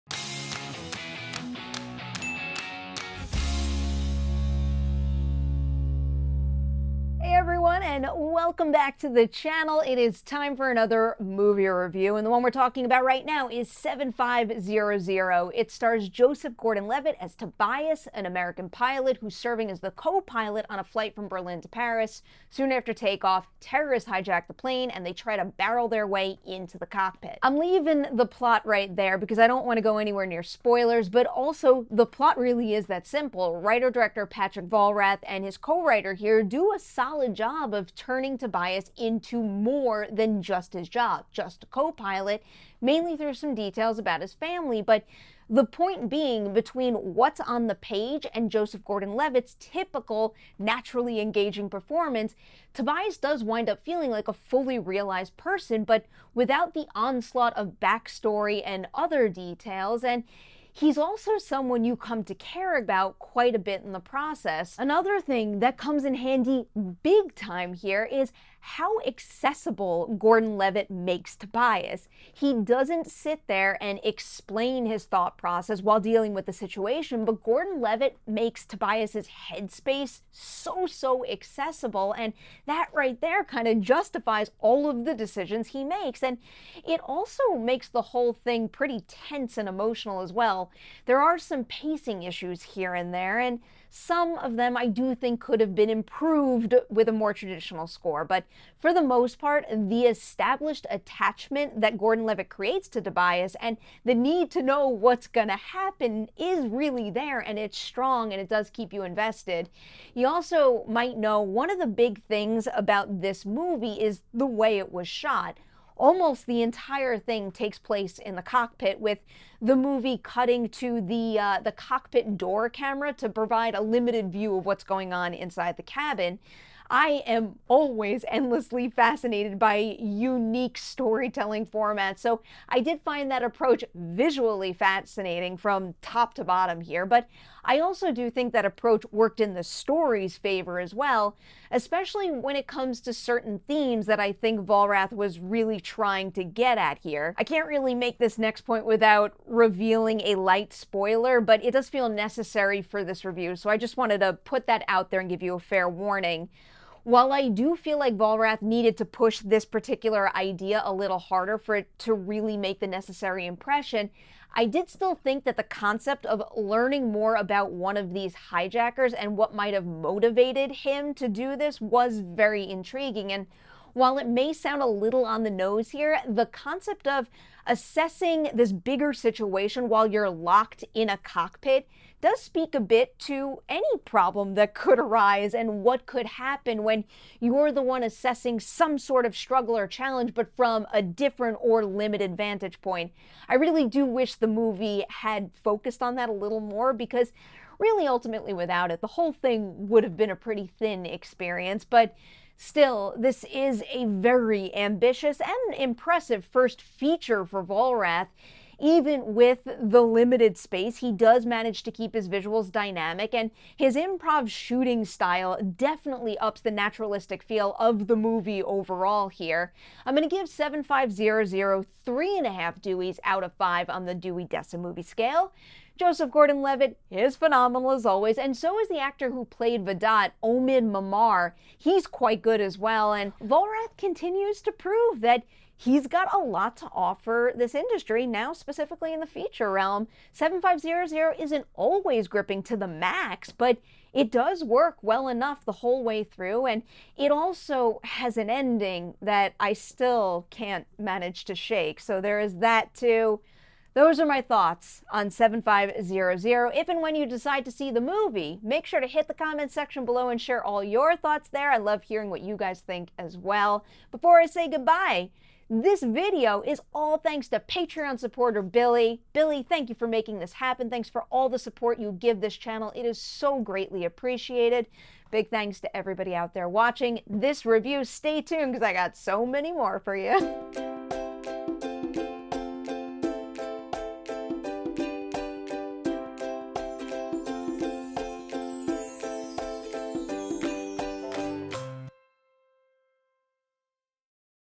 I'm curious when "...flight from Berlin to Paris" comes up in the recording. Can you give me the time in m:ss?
0:20.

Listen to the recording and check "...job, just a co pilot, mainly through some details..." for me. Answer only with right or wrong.
right.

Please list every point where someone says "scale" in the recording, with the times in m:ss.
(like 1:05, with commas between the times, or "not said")
3:45.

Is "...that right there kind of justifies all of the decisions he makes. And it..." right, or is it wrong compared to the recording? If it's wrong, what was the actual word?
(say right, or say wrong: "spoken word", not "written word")
right.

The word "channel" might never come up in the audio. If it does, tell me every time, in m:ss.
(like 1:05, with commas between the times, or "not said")
0:09, 4:32.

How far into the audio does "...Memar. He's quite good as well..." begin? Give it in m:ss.
3:50.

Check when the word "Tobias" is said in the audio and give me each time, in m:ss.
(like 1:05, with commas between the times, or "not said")
0:17, 0:38, 0:52, 1:11, 1:18, 1:43.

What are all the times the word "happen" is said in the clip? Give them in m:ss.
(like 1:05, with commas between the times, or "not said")
1:45, 3:06, 4:30.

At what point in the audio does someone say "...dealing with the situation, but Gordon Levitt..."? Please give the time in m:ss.
1:15.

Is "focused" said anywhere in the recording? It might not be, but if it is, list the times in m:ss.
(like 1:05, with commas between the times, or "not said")
3:15.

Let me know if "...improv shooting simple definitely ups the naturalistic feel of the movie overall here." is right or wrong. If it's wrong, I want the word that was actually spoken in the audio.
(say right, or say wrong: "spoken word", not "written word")
wrong: "style", not "simple".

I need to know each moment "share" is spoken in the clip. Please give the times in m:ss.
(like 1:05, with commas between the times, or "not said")
4:20.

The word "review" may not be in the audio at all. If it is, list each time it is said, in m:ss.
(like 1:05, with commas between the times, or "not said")
0:11, 2:33, 4:37.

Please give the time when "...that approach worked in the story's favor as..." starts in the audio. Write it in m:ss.
2:18.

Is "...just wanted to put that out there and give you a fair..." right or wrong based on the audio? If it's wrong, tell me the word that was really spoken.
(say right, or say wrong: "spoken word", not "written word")
right.